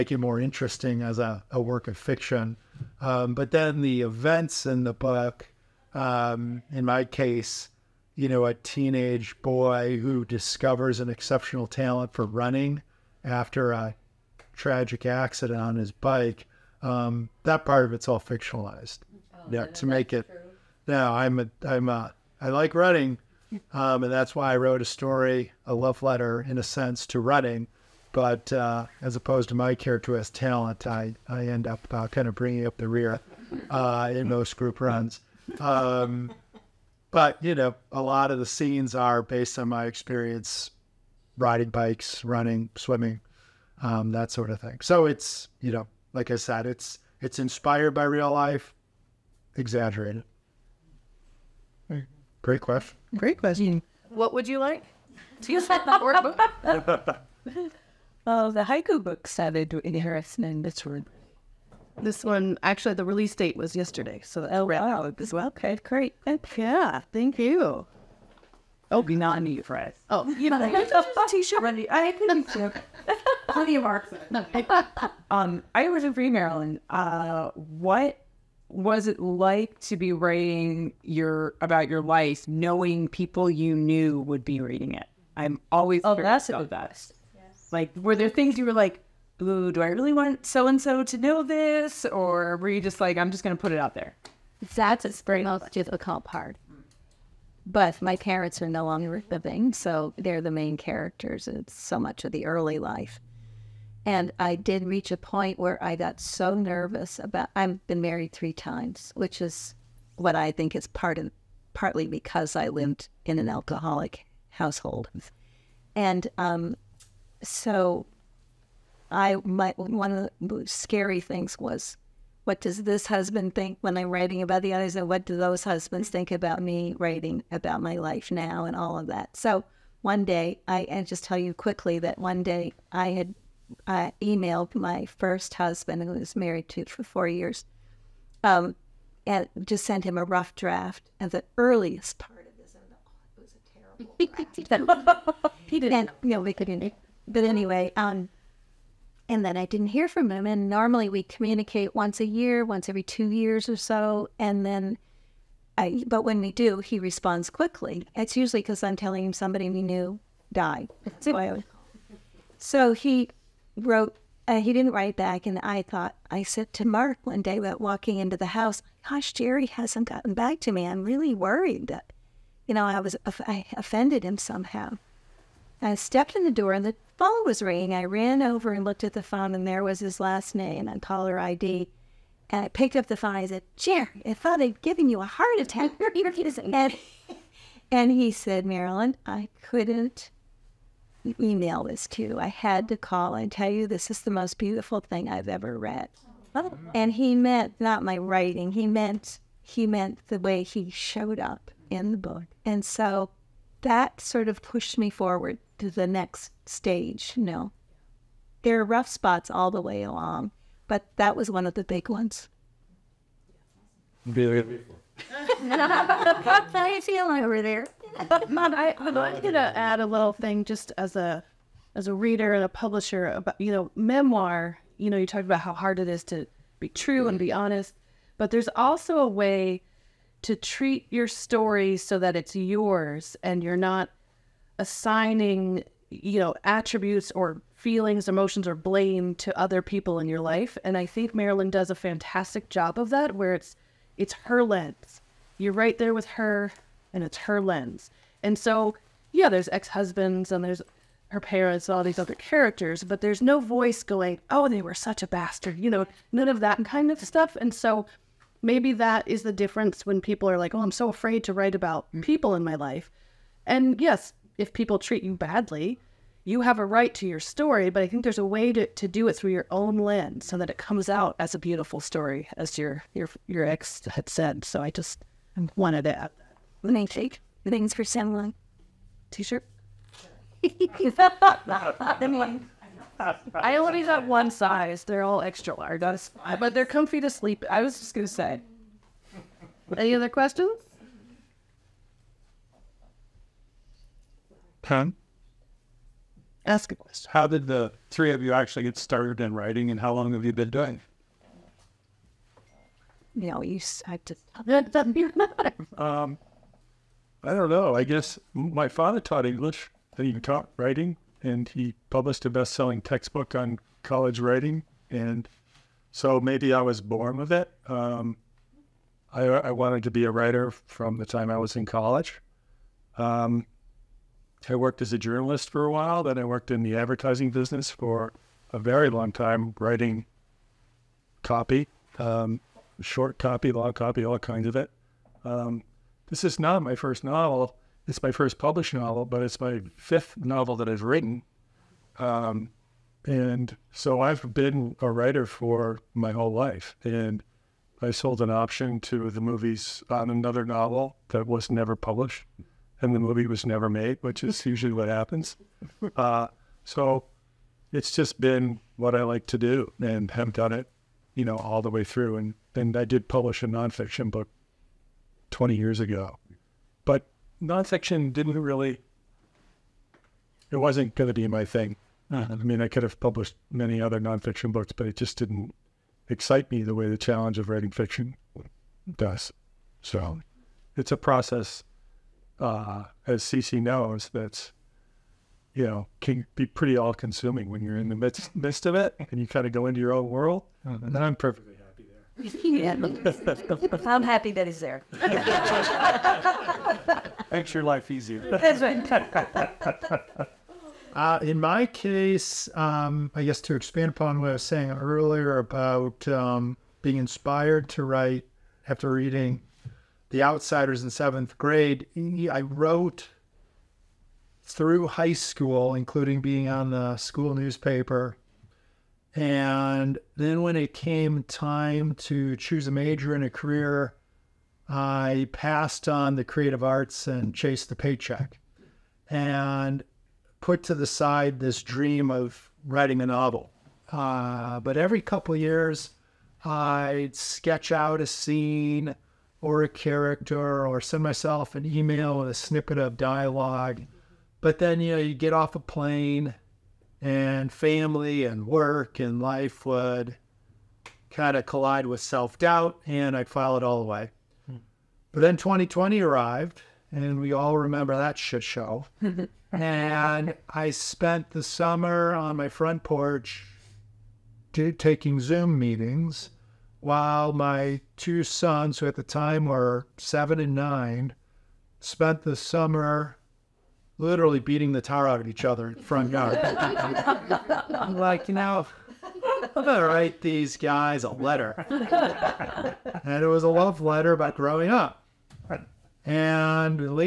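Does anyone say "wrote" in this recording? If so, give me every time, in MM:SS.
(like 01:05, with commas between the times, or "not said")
00:24, 02:43, 06:52.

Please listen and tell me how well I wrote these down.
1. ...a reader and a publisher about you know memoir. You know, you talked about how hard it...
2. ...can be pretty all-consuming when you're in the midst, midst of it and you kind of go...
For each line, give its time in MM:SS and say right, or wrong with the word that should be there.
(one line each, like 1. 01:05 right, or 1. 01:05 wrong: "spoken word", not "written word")
1. 03:42 right
2. 06:26 right.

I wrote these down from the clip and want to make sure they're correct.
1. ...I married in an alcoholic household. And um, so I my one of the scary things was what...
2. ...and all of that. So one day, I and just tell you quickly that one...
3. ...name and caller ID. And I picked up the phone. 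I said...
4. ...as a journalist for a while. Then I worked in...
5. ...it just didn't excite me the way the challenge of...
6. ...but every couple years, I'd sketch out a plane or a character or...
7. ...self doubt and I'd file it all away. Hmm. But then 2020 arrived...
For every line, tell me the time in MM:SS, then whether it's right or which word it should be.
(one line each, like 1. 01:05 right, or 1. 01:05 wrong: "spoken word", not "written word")
1. 01:52 wrong: "lived", not "married"
2. 02:08 right
3. 03:00 right
4. 05:25 right
5. 06:15 right
6. 07:14 wrong: "scene", not "plane"
7. 07:32 right.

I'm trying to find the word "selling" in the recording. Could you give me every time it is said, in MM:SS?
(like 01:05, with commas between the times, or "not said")
04:38, 05:12.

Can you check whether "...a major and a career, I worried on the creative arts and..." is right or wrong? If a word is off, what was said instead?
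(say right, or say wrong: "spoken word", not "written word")
wrong: "passed", not "worried".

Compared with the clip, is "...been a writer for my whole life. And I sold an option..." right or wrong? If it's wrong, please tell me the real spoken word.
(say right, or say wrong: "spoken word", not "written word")
right.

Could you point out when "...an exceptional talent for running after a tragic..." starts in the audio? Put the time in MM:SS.
00:10.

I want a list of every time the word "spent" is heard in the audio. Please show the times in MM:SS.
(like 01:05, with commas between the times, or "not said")
07:40, 07:51.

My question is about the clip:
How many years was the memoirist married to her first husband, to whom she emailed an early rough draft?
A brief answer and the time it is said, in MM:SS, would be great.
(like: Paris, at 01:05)
4, at 02:17.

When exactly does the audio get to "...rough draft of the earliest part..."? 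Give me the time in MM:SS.
02:20.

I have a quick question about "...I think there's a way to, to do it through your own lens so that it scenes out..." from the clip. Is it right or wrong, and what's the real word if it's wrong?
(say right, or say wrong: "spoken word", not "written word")
wrong: "comes", not "scenes".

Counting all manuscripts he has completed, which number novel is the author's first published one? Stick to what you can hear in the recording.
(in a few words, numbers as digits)
Fifth.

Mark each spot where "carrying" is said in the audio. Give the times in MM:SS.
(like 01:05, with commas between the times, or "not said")
not said.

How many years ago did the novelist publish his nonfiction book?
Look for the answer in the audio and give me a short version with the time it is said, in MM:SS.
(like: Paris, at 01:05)
20, at 06:05.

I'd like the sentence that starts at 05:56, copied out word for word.
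Uh, so it's just been what I like to do and have done it, you know, all the way through.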